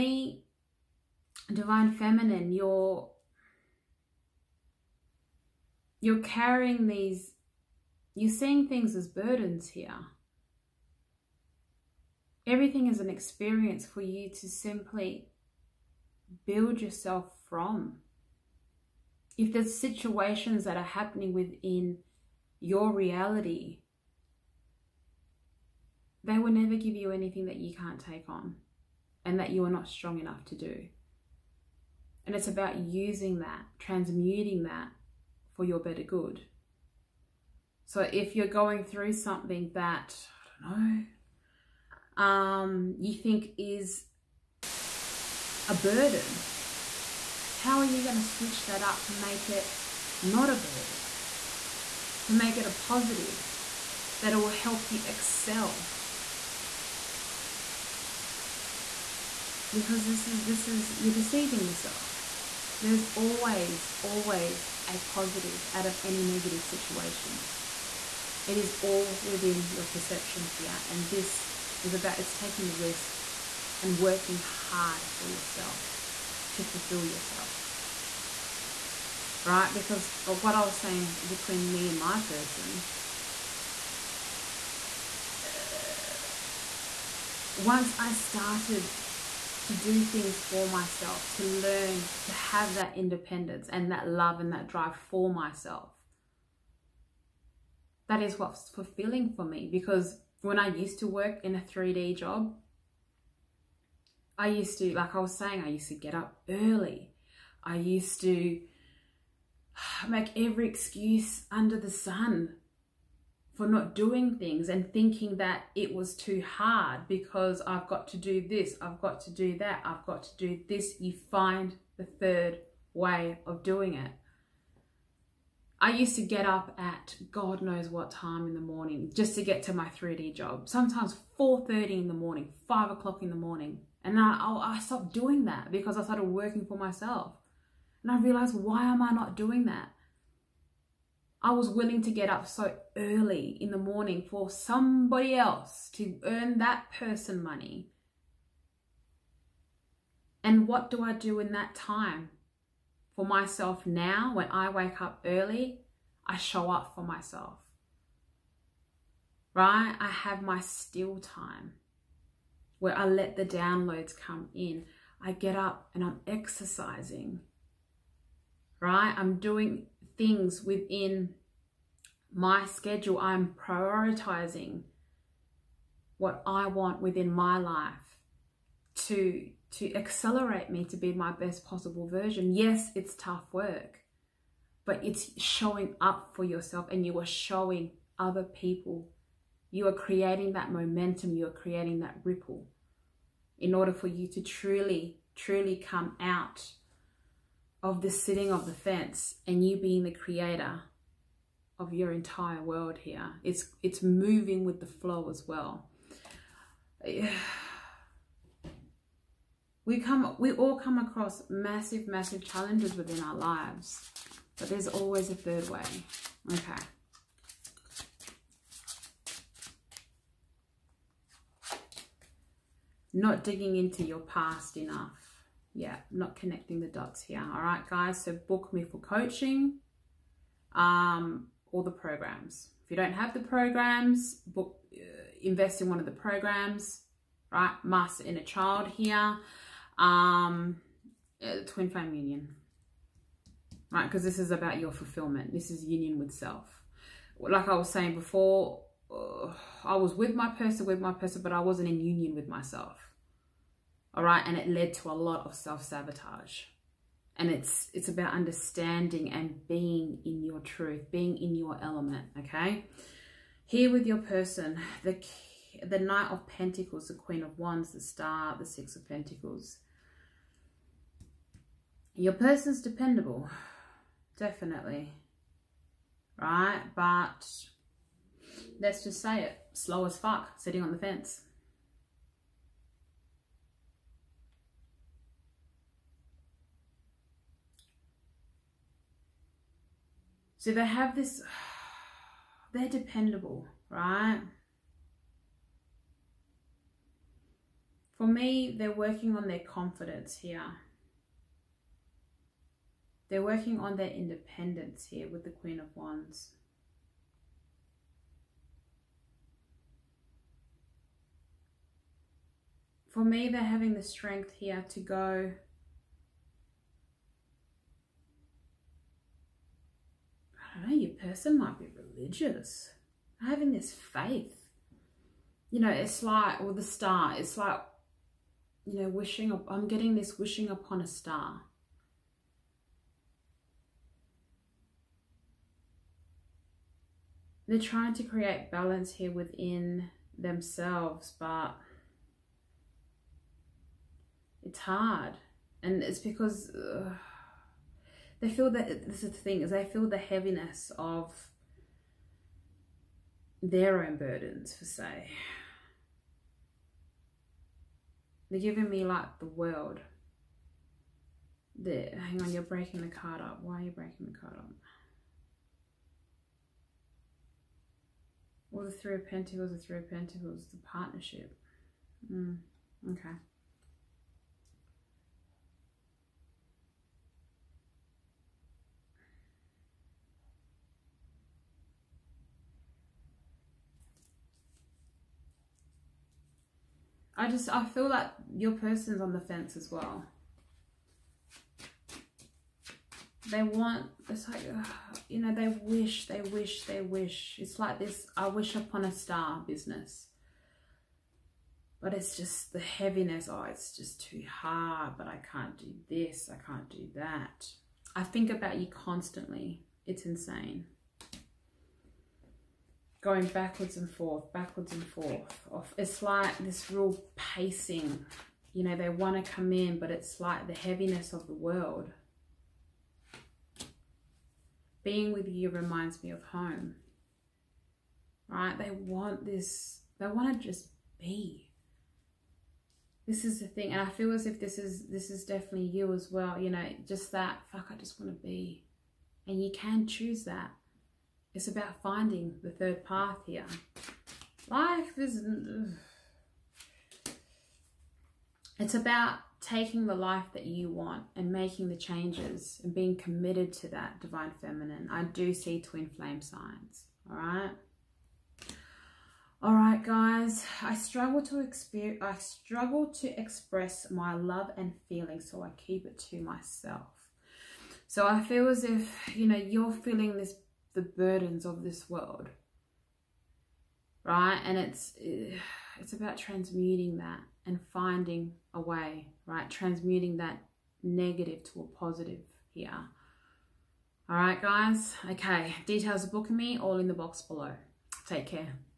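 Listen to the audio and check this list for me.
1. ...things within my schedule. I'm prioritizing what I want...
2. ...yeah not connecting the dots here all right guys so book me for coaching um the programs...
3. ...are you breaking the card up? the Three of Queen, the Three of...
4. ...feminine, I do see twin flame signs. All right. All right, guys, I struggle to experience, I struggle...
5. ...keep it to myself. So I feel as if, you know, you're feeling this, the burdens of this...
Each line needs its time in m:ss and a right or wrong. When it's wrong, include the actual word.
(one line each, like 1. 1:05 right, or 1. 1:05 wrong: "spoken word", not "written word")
1. 2:50 right
2. 3:45 right
3. 6:03 wrong: "Pentacles", not "Queen"
4. 7:34 right
5. 7:45 right.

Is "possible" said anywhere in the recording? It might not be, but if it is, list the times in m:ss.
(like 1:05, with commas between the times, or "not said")
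3:01.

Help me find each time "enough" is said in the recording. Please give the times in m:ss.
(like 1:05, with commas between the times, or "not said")
0:30, 3:44.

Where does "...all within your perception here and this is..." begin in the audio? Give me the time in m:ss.
1:08.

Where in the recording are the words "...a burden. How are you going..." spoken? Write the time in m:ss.
0:45.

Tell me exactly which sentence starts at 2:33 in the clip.
for myself now, when I wake up early, I show up for myself.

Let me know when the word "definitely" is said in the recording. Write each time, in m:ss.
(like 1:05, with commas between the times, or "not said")
4:34, 7:15.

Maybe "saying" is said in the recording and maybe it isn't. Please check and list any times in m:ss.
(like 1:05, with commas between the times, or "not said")
1:20, 1:45, 4:07.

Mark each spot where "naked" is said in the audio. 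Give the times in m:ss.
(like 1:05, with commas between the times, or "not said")
not said.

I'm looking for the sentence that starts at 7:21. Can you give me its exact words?
It's about finding the third path here.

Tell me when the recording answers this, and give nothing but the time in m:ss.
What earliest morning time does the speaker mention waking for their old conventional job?
2:11.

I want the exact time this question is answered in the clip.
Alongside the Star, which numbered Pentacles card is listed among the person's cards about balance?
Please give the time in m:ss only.
4:28.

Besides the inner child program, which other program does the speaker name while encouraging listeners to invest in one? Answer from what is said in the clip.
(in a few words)
Twin flame union.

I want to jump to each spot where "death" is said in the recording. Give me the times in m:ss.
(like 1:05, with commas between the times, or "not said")
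not said.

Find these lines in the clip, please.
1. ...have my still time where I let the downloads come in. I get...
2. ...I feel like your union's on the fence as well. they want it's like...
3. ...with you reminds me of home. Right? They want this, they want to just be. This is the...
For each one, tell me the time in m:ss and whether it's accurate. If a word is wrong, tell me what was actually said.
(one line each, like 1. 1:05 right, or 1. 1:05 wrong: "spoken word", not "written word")
1. 2:40 right
2. 6:27 wrong: "person", not "union"
3. 7:05 right.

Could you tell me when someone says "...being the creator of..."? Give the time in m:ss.
3:19.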